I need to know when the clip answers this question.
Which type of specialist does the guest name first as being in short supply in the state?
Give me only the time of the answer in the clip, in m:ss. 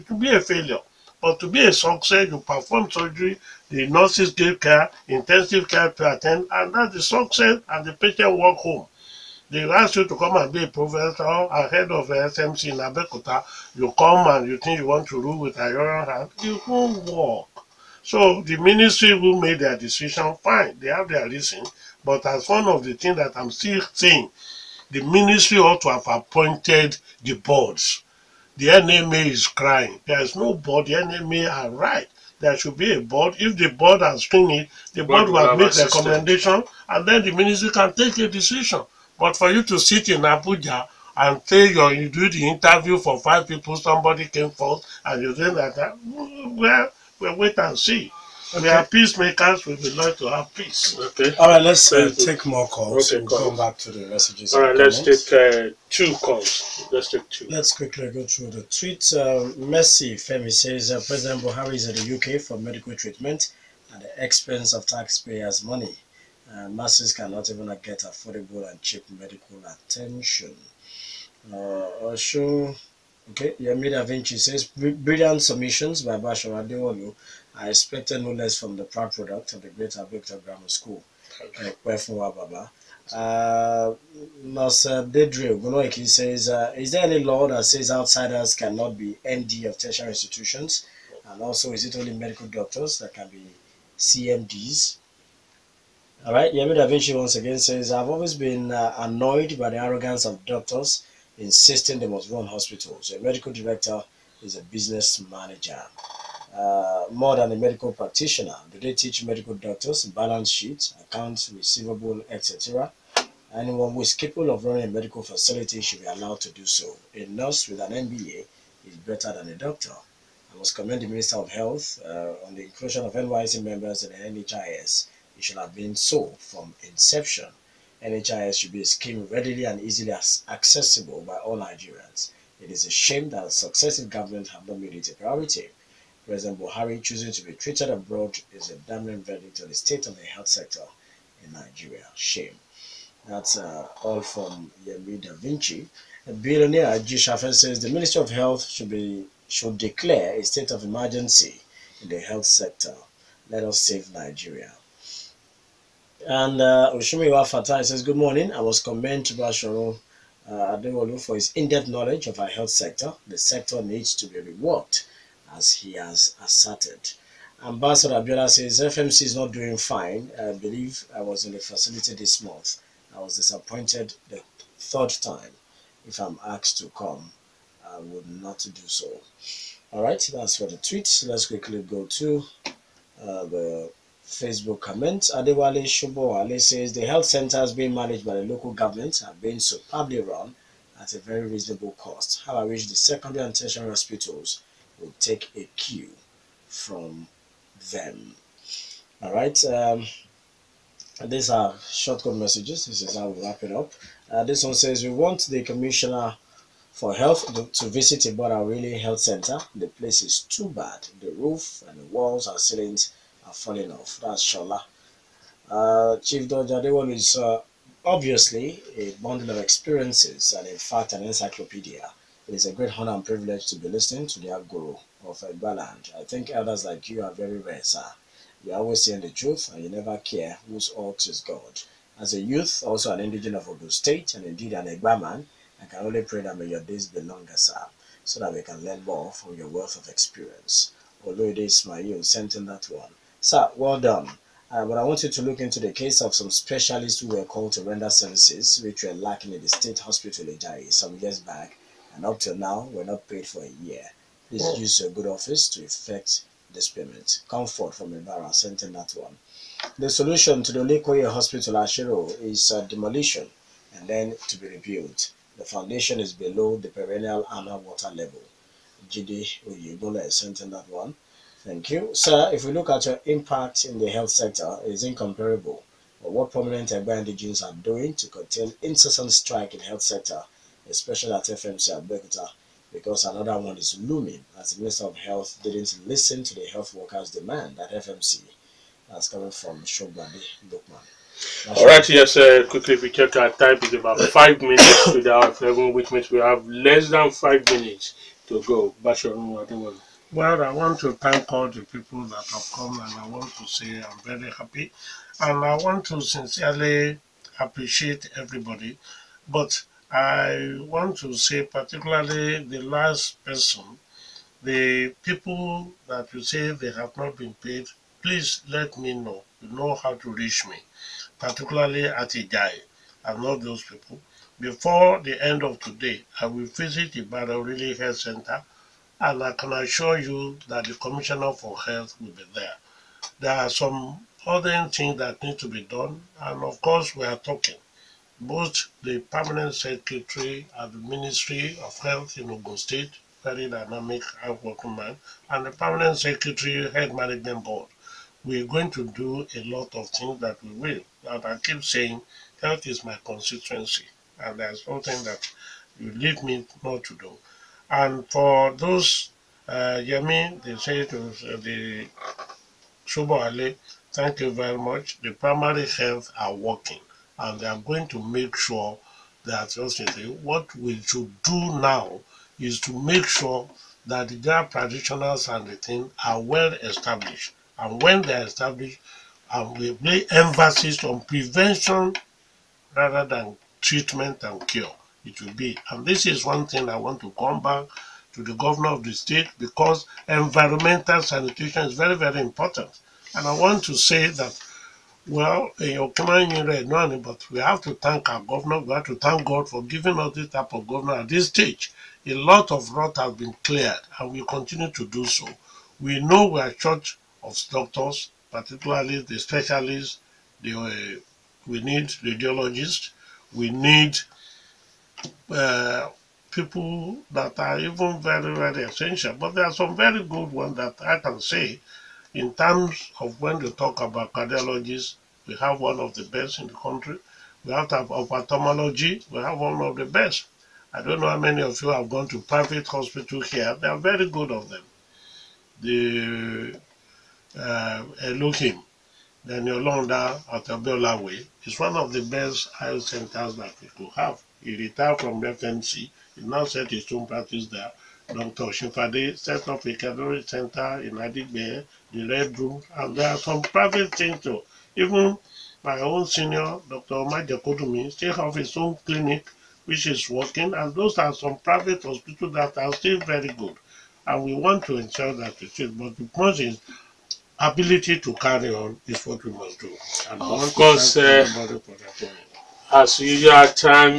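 6:52.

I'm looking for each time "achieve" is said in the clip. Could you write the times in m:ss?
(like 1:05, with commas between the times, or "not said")
not said.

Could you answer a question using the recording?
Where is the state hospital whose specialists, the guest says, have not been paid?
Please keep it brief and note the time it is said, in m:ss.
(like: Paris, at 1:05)
Ijai, at 5:22.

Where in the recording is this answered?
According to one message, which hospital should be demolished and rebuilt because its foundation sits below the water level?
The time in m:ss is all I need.
4:20.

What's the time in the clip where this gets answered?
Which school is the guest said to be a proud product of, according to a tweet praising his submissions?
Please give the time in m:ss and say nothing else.
1:20.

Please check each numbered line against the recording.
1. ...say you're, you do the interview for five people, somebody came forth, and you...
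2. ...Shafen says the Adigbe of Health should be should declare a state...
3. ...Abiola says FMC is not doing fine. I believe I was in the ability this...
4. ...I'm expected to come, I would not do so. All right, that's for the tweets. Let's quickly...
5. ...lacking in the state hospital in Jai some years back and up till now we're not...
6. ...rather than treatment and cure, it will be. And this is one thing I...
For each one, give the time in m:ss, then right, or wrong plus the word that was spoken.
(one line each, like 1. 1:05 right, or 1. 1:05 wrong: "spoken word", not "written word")
1. 0:41 right
2. 2:27 wrong: "Ministry", not "Adigbe"
3. 2:48 wrong: "facility", not "ability"
4. 2:56 wrong: "asked", not "expected"
5. 4:09 right
6. 6:22 right.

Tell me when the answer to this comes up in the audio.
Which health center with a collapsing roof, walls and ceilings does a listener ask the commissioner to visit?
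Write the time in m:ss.
3:28.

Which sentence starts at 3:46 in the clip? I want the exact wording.
I think others like you are very rare, sir.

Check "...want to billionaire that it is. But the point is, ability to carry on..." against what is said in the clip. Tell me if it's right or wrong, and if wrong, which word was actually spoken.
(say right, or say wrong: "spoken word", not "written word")
wrong: "ensure", not "billionaire".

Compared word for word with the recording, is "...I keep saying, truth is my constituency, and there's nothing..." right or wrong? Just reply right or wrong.
wrong.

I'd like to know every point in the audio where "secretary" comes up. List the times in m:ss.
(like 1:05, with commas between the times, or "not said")
5:39, 5:46.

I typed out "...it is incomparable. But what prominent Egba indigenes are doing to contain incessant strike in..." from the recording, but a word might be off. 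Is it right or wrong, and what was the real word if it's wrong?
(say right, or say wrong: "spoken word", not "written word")
right.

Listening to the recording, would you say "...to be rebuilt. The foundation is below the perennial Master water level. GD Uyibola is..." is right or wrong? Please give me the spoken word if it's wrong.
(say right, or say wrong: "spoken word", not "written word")
wrong: "Anna", not "Master".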